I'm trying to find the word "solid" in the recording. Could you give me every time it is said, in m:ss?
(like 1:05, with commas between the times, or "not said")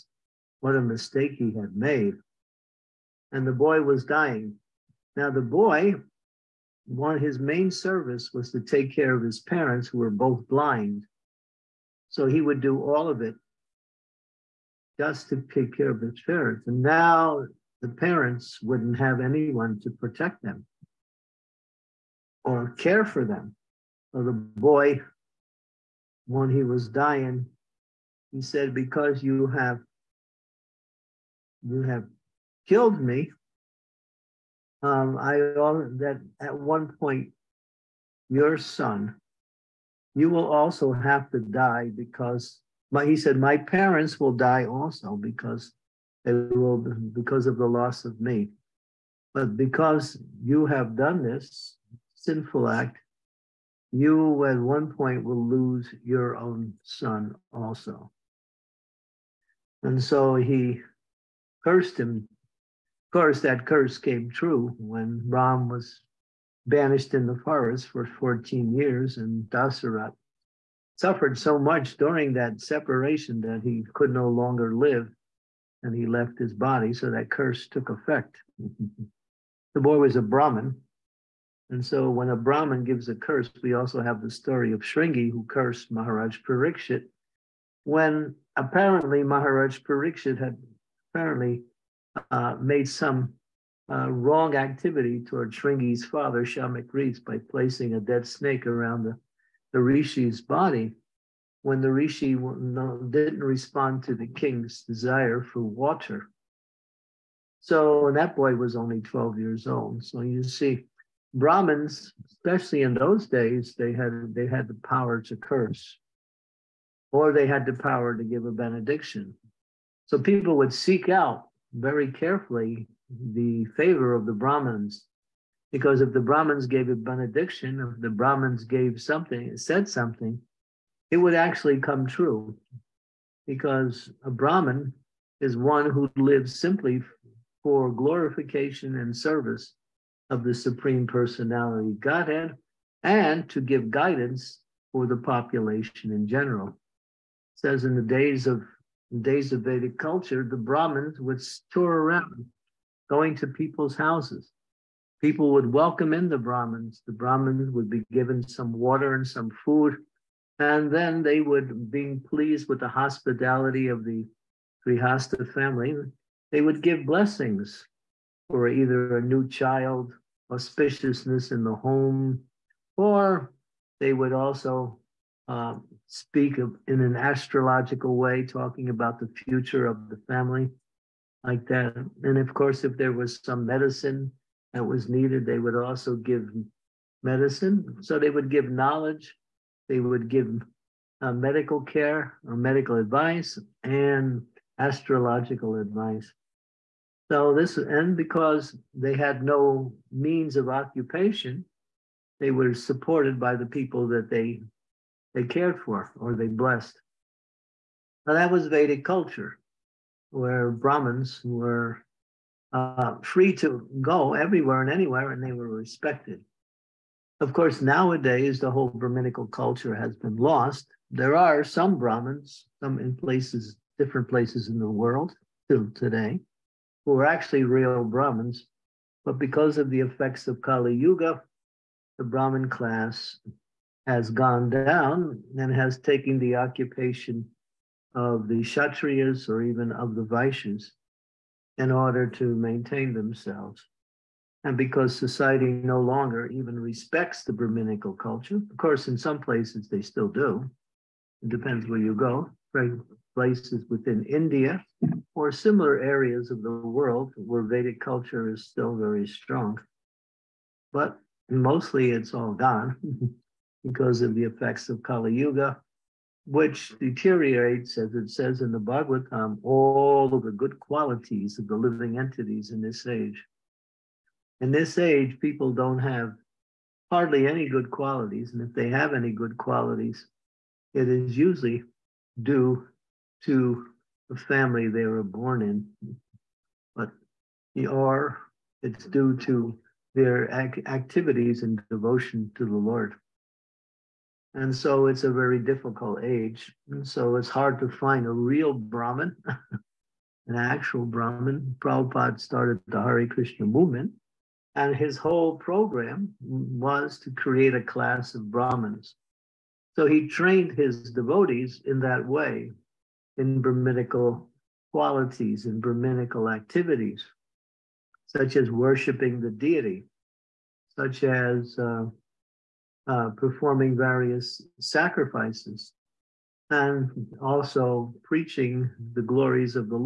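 not said.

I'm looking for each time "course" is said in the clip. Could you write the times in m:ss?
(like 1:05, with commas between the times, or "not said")
1:03, 3:02, 3:37, 4:08.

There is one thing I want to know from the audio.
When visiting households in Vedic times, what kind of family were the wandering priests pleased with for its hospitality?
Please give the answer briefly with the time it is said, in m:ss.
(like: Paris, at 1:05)
Grihasta, at 2:44.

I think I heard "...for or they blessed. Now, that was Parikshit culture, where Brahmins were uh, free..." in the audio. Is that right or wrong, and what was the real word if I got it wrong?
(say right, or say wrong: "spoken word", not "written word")
wrong: "Vedic", not "Parikshit".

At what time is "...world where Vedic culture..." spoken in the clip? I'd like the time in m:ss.
4:16.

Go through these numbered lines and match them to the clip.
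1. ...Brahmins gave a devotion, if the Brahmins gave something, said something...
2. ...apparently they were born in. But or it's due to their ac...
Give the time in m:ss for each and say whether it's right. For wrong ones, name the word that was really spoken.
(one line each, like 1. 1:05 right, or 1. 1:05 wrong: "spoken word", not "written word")
1. 2:06 wrong: "benediction", not "devotion"
2. 4:44 wrong: "family", not "apparently".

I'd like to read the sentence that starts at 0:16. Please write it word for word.
And now the parents wouldn't have anyone to protect them or care for them.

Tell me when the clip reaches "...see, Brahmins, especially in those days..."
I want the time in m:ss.
1:50.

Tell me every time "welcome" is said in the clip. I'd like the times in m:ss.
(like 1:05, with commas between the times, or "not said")
2:35.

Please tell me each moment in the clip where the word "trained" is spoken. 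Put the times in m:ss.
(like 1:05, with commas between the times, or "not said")
5:10.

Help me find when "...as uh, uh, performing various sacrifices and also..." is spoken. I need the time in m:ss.
5:21.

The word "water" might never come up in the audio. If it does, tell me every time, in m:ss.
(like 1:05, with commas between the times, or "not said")
1:45, 2:38.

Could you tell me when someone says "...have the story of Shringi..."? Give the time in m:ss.
1:24.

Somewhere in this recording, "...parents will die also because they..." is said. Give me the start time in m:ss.
0:43.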